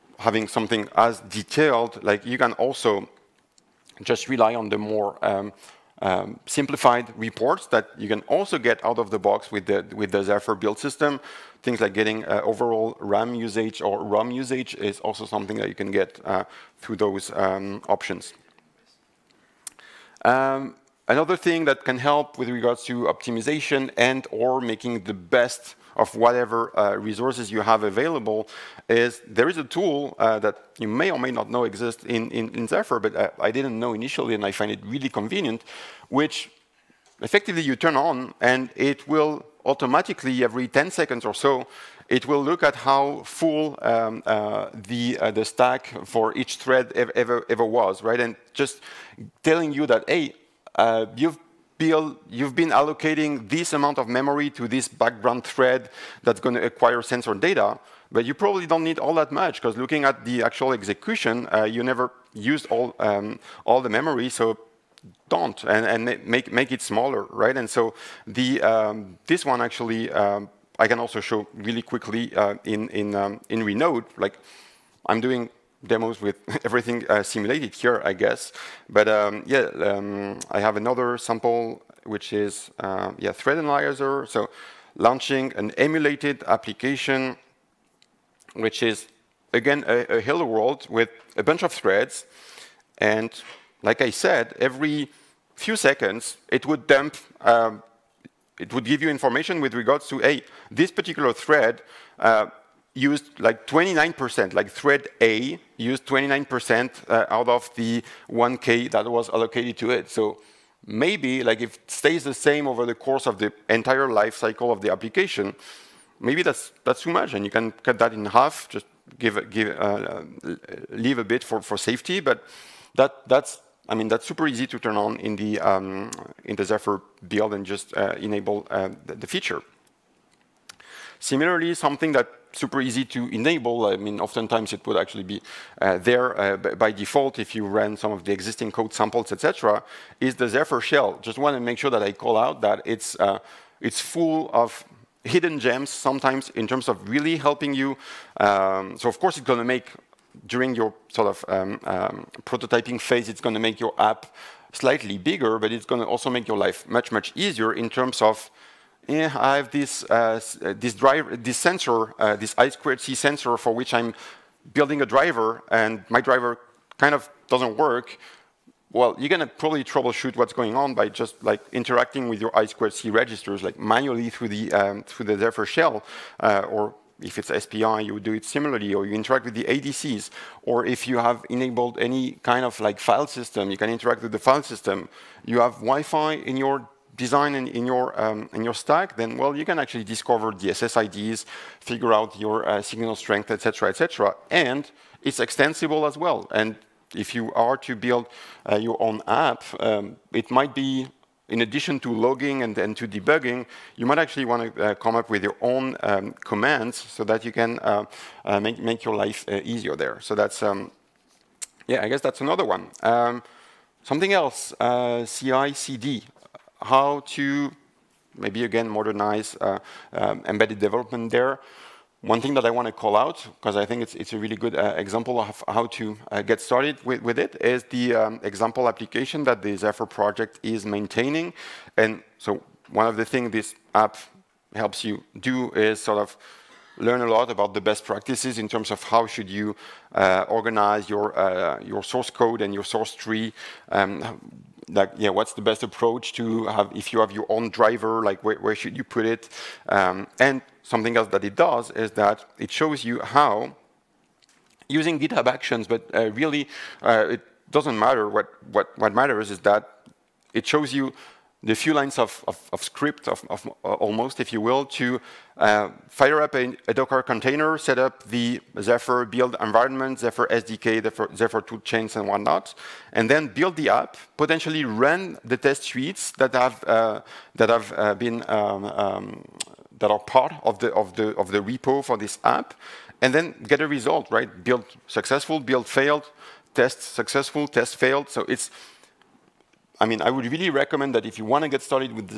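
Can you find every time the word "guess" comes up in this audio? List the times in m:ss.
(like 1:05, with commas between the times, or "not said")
1:18, 3:32.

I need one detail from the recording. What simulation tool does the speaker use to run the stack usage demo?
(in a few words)
Renode.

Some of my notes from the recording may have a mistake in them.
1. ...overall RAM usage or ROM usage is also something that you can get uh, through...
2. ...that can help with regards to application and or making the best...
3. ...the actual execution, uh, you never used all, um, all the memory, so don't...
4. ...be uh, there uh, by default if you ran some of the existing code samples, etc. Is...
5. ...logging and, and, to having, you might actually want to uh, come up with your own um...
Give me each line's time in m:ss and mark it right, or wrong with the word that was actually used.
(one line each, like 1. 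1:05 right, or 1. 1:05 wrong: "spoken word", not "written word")
1. 0:12 right
2. 0:21 wrong: "optimization", not "application"
3. 1:00 right
4. 2:15 right
5. 3:22 wrong: "debugging", not "having".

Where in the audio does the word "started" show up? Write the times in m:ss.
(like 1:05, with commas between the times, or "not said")
3:46, 4:51.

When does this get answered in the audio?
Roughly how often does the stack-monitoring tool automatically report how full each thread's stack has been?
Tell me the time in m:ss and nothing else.
0:40.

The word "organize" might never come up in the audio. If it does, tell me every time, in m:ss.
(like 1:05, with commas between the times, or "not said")
4:00.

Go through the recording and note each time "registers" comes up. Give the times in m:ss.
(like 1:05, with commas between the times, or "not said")
2:53.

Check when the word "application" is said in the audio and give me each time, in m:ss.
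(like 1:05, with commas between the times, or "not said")
1:26, 1:54, 3:48.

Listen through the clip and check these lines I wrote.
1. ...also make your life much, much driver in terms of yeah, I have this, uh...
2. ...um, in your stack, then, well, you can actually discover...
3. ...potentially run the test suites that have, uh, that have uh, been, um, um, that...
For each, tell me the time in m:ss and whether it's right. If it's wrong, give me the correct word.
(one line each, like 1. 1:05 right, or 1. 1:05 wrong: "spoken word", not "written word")
1. 2:36 wrong: "easier", not "driver"
2. 3:08 right
3. 4:34 right.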